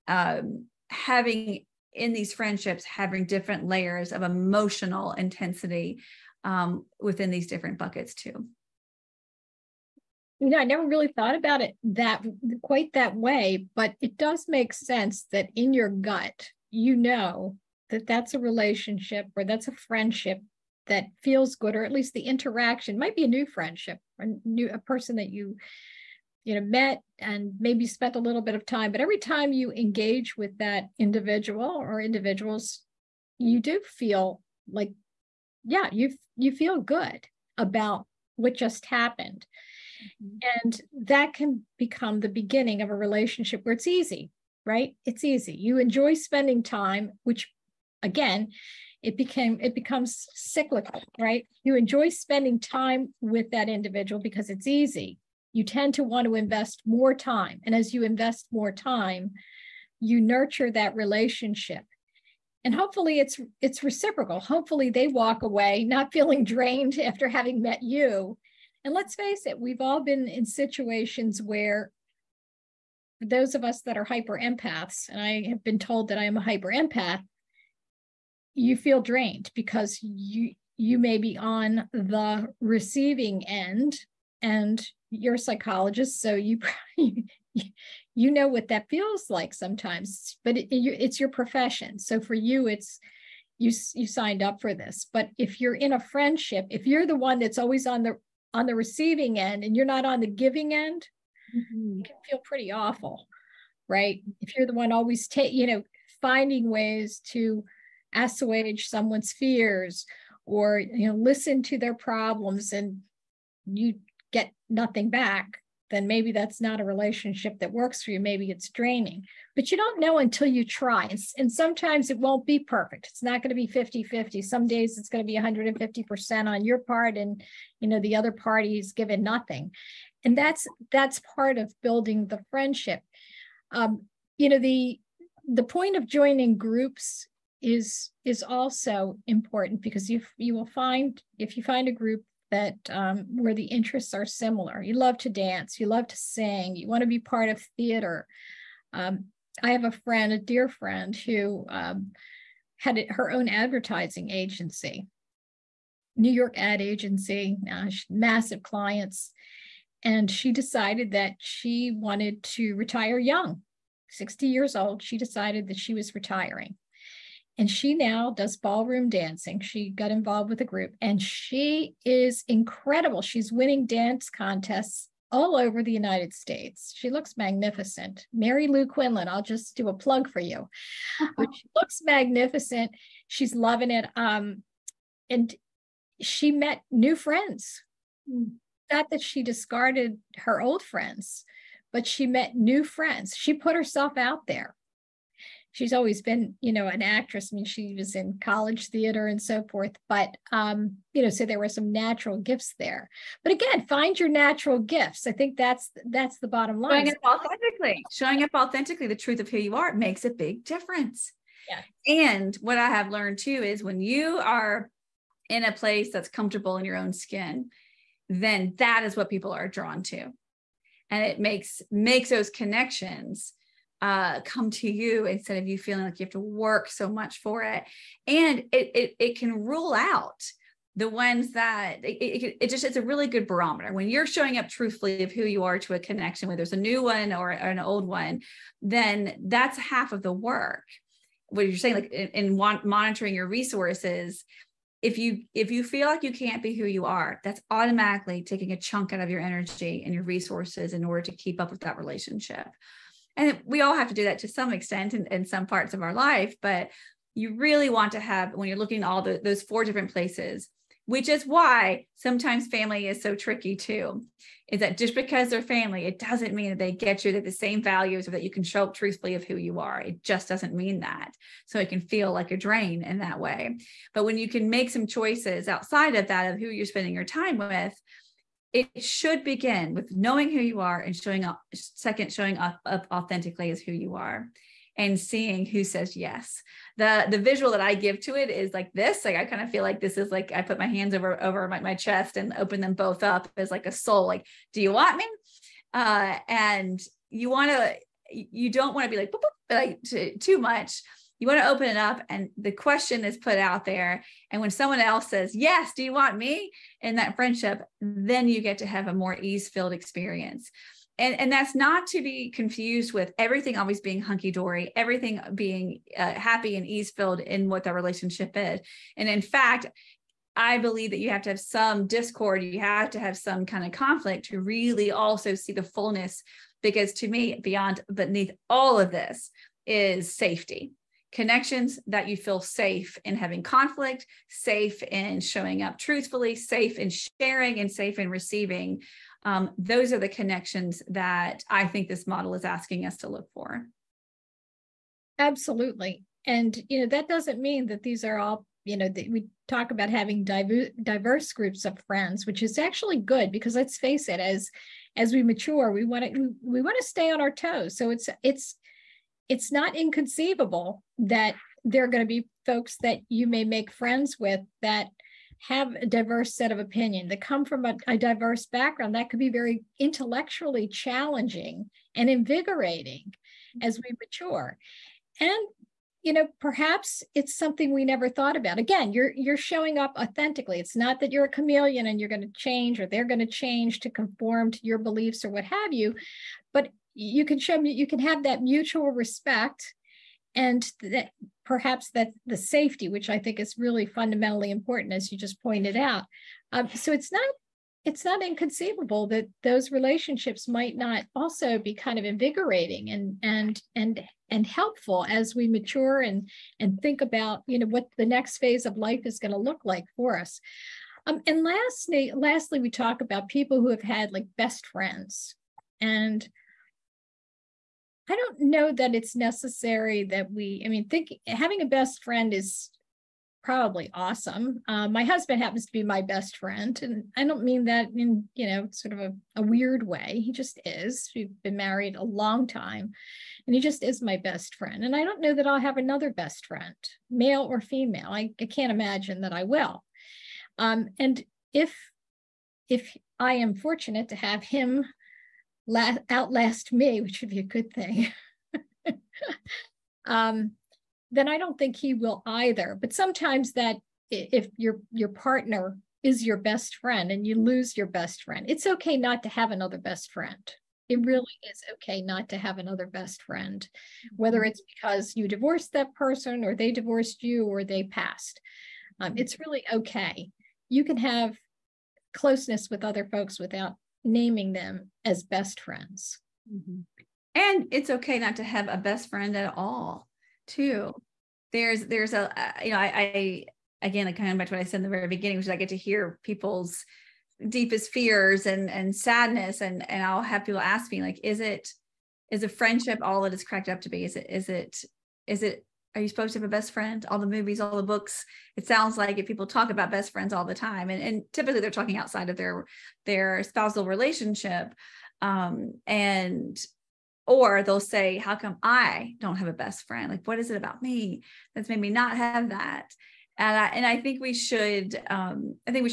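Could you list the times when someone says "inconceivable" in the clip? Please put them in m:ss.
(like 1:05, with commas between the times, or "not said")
5:59, 6:38.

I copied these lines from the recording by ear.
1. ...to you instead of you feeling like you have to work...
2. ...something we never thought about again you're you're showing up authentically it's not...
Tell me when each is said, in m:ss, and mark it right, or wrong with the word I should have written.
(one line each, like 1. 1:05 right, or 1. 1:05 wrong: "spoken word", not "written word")
1. 3:44 right
2. 6:17 right.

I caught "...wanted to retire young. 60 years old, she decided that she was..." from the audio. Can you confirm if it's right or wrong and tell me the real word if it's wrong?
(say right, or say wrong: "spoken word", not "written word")
right.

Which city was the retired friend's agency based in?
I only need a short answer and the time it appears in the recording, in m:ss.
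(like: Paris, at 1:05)
New York, at 2:36.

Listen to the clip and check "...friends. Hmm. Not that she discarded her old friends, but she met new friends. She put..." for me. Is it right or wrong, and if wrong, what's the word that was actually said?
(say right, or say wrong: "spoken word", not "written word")
right.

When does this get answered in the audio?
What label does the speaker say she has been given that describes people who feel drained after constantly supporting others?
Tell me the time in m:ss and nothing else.
1:16.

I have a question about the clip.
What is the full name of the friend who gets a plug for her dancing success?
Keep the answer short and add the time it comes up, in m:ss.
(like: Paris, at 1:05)
Mary Lou Quinlan, at 2:58.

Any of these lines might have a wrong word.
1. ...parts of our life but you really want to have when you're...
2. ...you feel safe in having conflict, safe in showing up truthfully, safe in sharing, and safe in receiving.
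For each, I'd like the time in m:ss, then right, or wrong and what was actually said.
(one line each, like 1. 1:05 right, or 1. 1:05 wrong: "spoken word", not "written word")
1. 4:15 right
2. 5:32 right.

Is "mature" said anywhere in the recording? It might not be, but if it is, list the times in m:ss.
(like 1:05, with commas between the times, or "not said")
5:55, 6:14, 6:45.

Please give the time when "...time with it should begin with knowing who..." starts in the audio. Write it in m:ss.
4:37.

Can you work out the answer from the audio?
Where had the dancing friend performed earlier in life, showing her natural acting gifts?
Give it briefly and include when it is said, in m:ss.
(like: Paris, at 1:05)
college theater, at 3:18.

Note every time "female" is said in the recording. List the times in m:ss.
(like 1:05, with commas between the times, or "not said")
7:17.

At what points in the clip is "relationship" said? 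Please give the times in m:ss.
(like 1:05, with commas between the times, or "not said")
0:18, 0:42, 1:00, 1:56, 4:11, 5:17, 6:39, 8:24.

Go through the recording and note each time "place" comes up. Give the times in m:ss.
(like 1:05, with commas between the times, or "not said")
3:35, 4:20.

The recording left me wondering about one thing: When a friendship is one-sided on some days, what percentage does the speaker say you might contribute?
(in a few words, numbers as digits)
150%.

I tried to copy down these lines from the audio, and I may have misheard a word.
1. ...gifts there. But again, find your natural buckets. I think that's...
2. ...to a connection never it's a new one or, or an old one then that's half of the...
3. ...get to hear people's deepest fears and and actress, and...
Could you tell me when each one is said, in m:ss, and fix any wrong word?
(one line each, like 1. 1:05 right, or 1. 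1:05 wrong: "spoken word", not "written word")
1. 3:22 wrong: "gifts", not "buckets"
2. 3:55 wrong: "whether", not "never"
3. 8:05 wrong: "sadness", not "actress".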